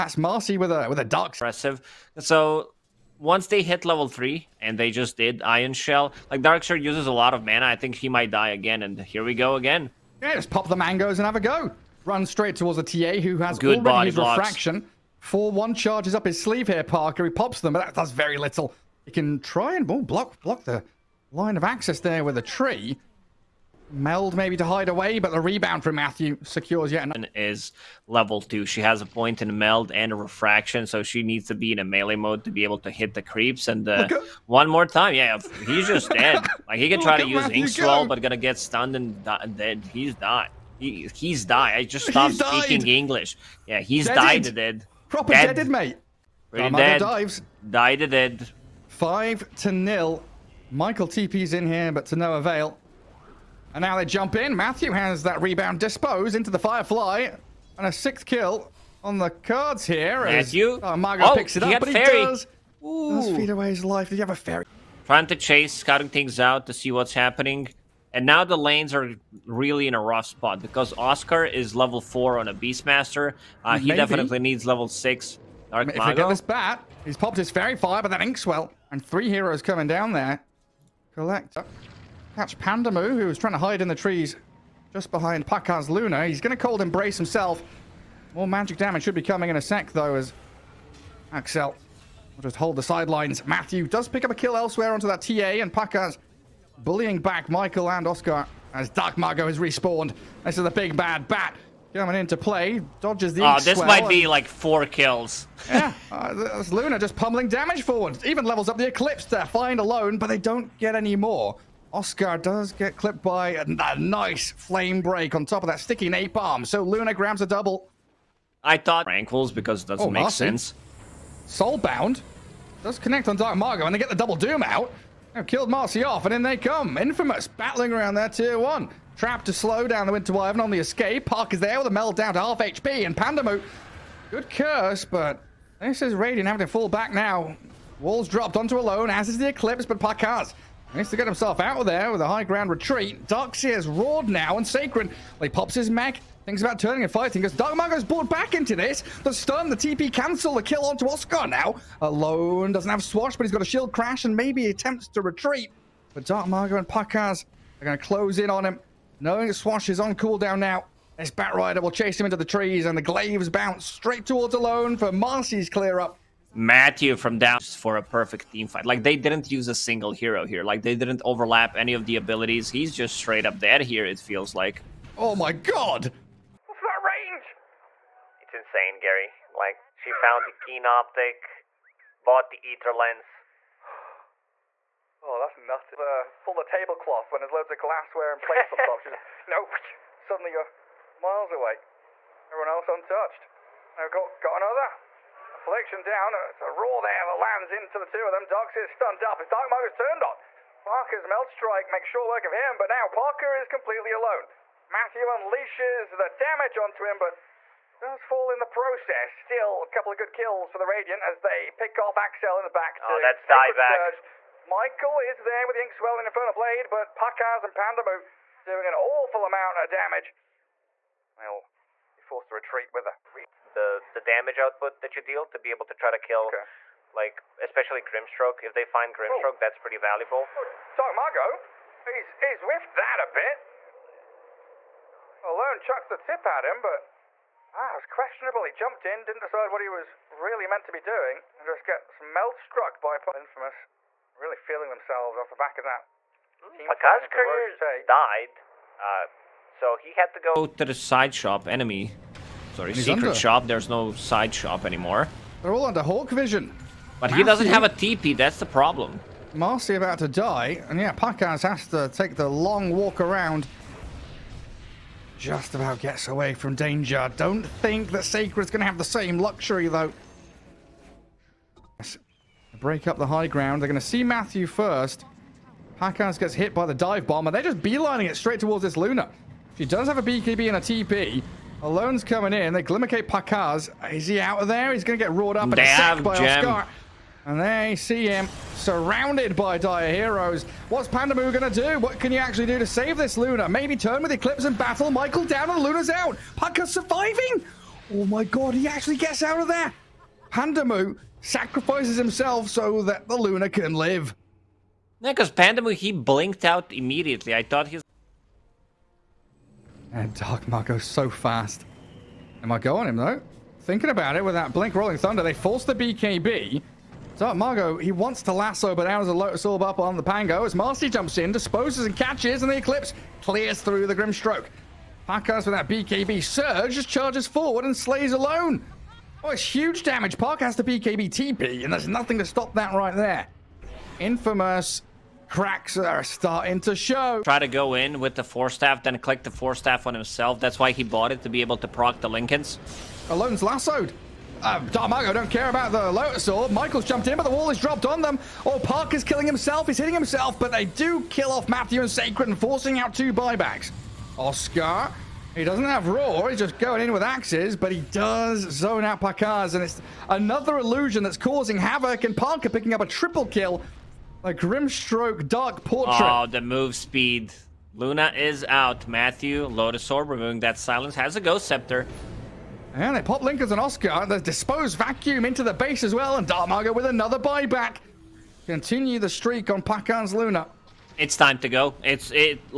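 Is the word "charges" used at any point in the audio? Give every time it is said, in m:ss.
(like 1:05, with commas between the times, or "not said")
0:15, 5:27.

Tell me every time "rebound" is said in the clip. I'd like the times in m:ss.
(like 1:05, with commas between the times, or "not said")
0:25, 0:55.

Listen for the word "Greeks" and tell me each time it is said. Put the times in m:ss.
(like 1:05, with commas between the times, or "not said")
not said.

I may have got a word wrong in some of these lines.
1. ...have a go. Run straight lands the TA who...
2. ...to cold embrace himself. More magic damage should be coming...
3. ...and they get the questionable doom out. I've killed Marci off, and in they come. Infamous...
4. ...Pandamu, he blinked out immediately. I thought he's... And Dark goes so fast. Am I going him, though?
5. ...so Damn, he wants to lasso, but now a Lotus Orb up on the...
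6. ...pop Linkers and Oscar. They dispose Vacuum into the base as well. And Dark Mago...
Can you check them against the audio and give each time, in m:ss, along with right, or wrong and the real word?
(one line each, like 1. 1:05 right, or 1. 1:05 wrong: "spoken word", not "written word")
1. 0:11 wrong: "towards", not "lands"
2. 1:26 right
3. 2:03 wrong: "double", not "questionable"
4. 5:05 right
5. 5:17 wrong: "Mago", not "Damn"
6. 6:13 right.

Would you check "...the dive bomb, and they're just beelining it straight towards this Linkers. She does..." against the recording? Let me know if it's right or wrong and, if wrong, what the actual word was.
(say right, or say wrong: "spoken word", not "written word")
wrong: "Luna", not "Linkers".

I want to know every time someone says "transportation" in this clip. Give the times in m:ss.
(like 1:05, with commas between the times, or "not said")
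not said.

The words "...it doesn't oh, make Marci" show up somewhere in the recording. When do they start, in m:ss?
1:59.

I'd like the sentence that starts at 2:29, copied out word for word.
The stun, the TP cancel, the kill onto Oscar now.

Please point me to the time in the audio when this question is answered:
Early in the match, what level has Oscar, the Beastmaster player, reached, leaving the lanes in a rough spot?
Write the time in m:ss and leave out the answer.
1:11.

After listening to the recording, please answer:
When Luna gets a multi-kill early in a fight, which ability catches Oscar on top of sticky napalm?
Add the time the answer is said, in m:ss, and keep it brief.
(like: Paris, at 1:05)
Flamebreak, at 1:54.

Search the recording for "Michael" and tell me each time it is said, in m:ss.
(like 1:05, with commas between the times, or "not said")
0:50, 1:37, 3:34, 4:55, 5:46.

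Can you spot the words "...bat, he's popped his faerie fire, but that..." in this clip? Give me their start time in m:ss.
1:16.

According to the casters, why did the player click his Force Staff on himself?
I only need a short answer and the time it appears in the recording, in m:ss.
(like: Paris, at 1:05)
To proc the Linken's, at 5:41.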